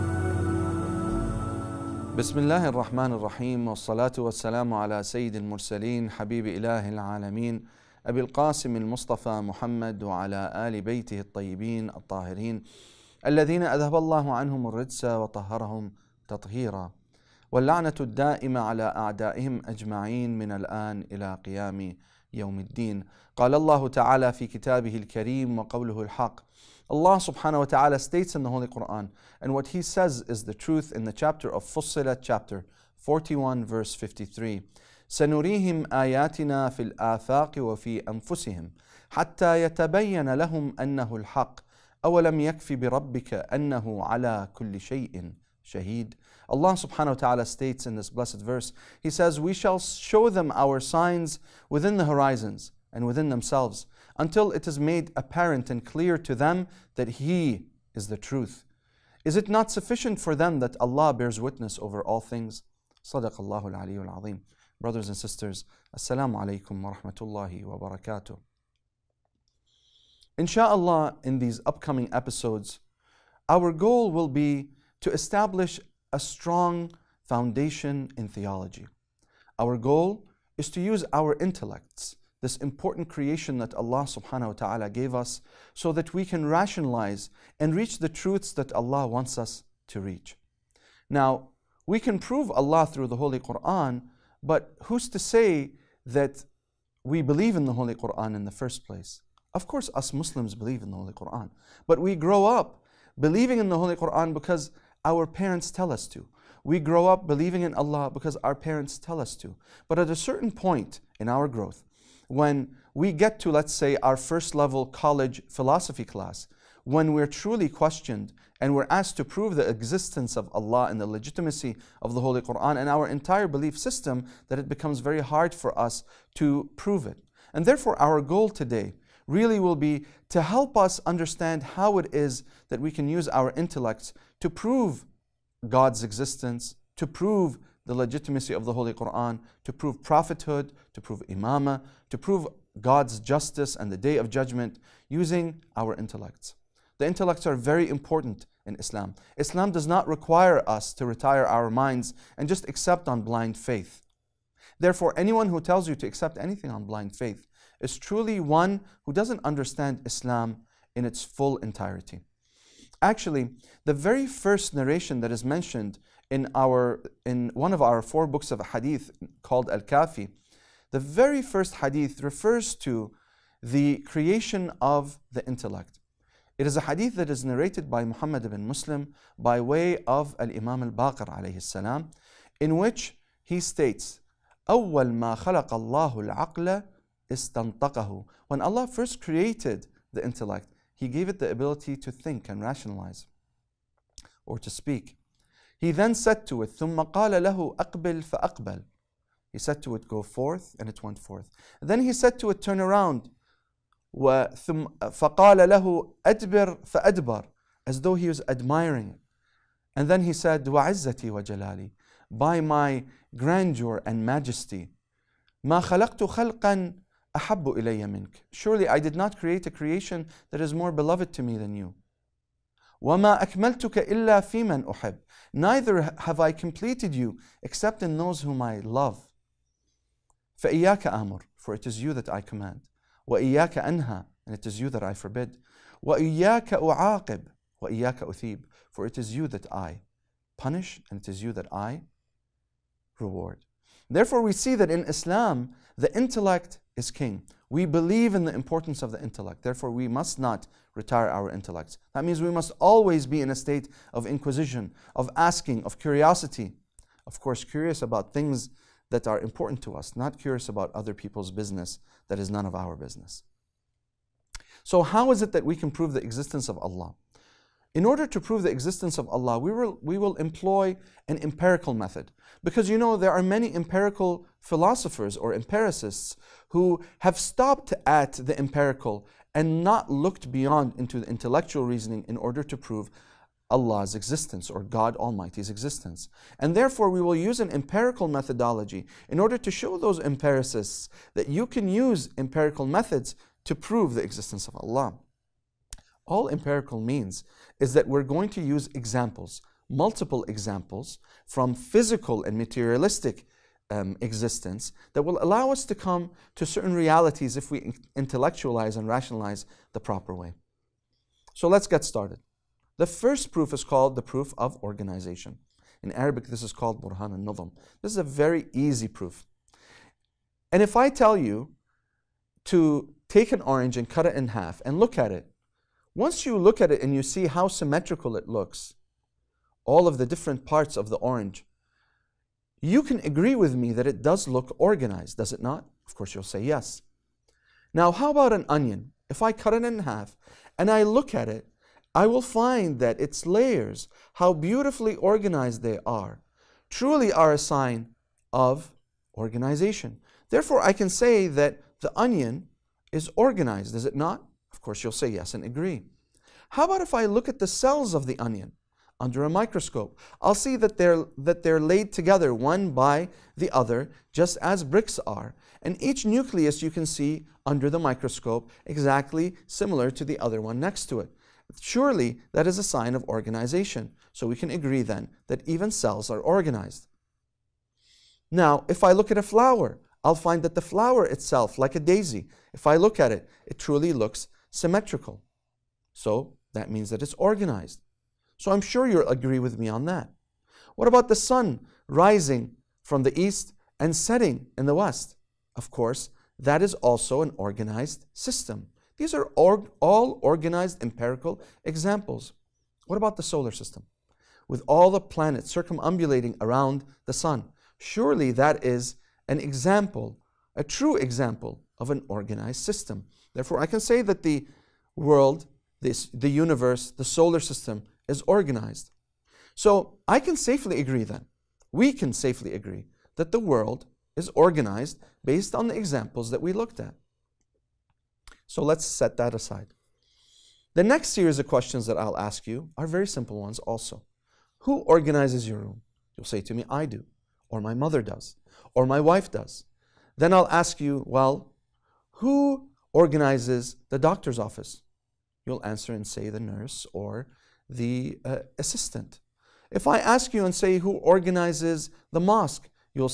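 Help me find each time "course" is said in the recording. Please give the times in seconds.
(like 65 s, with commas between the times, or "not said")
99 s, 257 s, 336 s, 354 s, 395 s.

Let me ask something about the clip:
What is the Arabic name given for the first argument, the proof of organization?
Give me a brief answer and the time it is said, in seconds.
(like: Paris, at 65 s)
Burhan al Nizam, at 317 s.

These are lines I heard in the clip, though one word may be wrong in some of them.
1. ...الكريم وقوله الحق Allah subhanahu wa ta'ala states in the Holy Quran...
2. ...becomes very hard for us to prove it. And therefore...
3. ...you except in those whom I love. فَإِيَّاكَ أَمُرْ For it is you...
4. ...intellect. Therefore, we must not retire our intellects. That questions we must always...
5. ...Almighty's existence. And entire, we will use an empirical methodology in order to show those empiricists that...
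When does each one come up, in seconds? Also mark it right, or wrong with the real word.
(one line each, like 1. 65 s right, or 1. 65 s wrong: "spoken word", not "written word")
1. 24 s right
2. 124 s right
3. 227 s right
4. 249 s wrong: "means", not "questions"
5. 285 s wrong: "therefore", not "entire".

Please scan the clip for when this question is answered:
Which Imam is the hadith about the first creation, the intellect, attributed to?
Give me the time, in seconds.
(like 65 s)
180 s.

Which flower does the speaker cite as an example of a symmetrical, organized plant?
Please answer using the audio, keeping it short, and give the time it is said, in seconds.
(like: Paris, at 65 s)
Daisy, at 381 s.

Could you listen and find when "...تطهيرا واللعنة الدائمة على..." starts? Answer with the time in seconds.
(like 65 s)
16 s.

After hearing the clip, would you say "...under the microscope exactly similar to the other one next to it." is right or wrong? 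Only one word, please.
right.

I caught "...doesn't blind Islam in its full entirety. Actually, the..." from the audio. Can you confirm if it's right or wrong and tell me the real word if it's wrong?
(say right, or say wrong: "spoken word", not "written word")
wrong: "understand", not "blind".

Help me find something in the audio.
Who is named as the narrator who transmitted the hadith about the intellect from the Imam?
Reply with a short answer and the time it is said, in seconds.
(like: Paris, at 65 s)
Muhammad ibn Muslim, at 178 s.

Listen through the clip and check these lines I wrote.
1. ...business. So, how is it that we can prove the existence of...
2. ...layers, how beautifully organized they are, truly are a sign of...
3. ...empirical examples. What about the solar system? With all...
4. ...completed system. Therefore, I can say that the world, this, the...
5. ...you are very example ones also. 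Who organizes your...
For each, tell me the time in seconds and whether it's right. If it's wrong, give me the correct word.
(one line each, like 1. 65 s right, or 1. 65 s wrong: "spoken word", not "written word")
1. 262 s right
2. 343 s right
3. 401 s right
4. 412 s wrong: "organized", not "completed"
5. 432 s wrong: "simple", not "example".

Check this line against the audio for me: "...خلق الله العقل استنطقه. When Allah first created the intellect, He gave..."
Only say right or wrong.
right.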